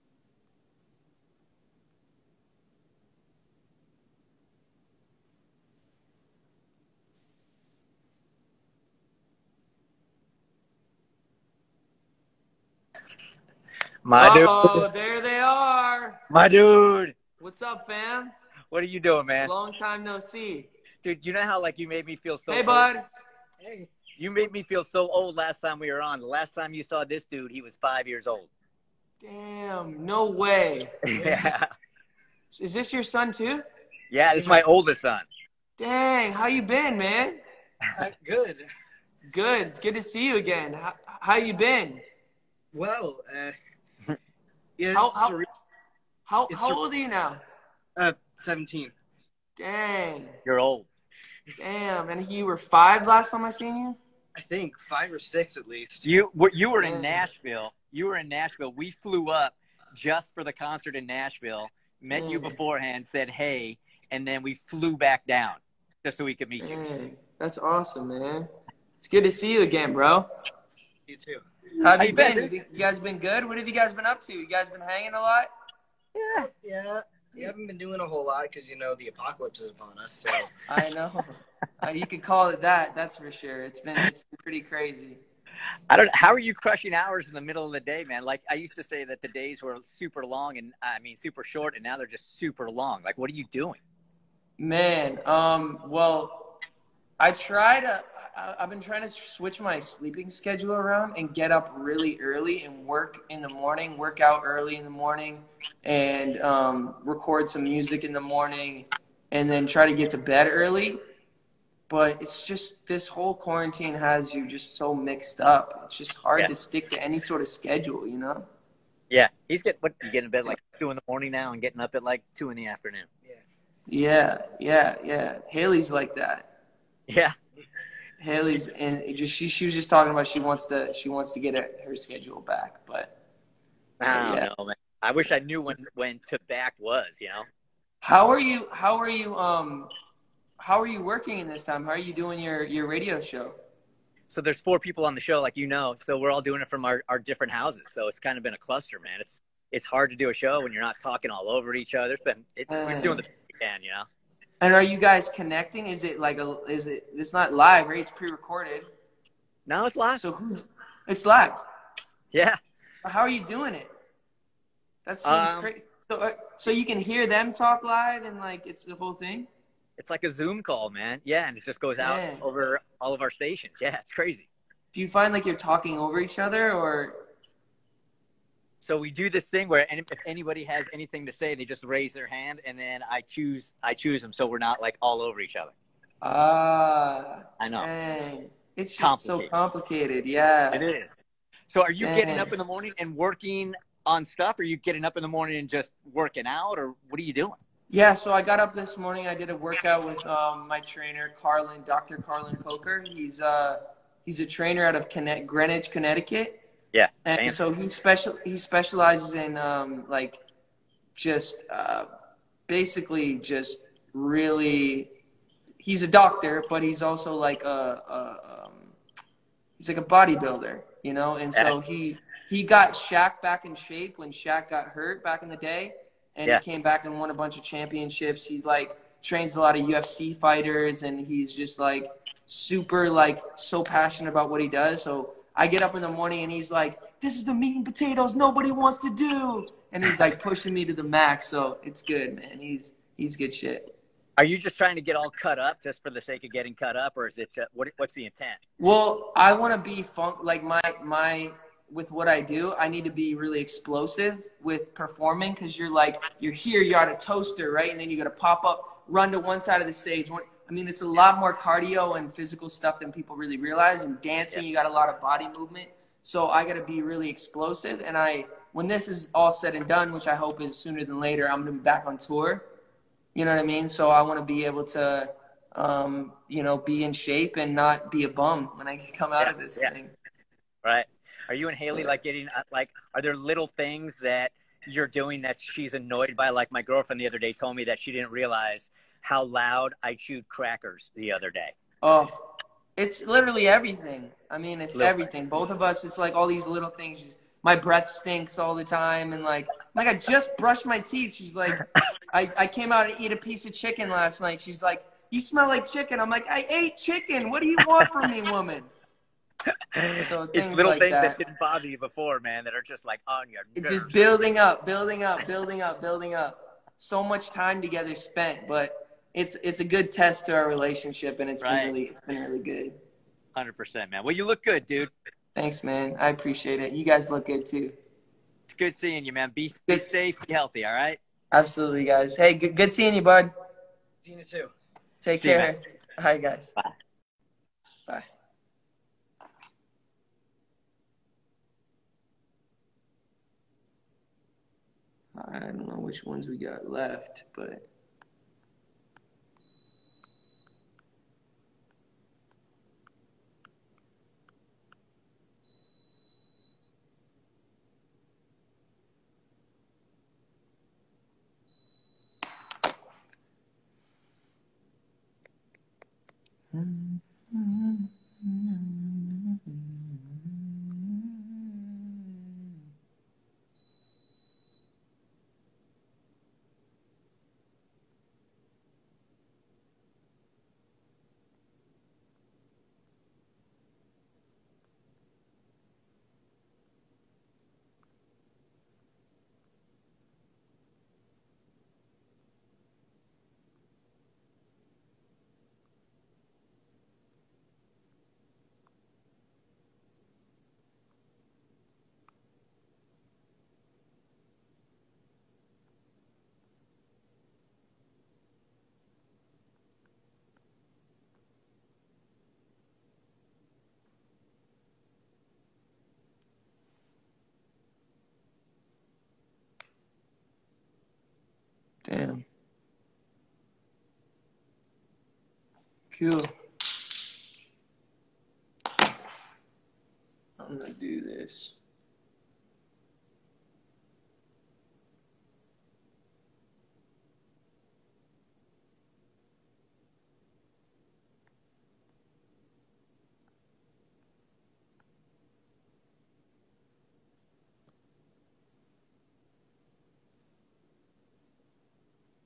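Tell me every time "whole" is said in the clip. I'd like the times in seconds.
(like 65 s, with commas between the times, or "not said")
78 s, 113 s, 168 s.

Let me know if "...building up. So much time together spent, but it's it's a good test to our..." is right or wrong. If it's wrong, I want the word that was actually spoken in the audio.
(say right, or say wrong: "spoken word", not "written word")
right.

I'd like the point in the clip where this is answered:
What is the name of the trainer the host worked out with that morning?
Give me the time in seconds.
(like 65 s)
201 s.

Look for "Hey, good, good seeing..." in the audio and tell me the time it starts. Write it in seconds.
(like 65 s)
332 s.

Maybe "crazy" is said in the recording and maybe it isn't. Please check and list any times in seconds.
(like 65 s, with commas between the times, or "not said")
84 s, 165 s, 174 s.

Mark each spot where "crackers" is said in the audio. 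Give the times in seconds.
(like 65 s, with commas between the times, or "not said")
290 s.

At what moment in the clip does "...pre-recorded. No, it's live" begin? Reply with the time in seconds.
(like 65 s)
158 s.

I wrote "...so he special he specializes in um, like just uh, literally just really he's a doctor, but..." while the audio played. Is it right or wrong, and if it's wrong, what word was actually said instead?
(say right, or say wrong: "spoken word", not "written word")
wrong: "basically", not "literally".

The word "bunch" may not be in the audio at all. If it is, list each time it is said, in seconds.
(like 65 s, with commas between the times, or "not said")
227 s.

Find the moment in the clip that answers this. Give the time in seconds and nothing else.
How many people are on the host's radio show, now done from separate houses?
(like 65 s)
144 s.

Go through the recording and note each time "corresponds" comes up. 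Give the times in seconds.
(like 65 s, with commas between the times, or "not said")
not said.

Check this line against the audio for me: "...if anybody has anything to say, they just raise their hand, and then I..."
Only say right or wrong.
right.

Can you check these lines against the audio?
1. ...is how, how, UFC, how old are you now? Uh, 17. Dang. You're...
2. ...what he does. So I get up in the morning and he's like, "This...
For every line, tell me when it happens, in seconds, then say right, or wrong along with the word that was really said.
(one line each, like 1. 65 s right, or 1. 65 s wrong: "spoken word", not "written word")
1. 44 s wrong: "How", not "UFC"
2. 234 s right.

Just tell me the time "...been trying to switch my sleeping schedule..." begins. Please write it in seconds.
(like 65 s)
98 s.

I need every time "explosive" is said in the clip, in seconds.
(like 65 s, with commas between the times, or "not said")
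253 s, 267 s.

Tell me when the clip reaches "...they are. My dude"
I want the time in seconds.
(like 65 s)
15 s.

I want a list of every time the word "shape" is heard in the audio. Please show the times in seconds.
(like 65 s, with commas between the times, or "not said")
223 s, 277 s.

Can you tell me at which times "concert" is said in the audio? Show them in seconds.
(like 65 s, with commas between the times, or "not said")
60 s.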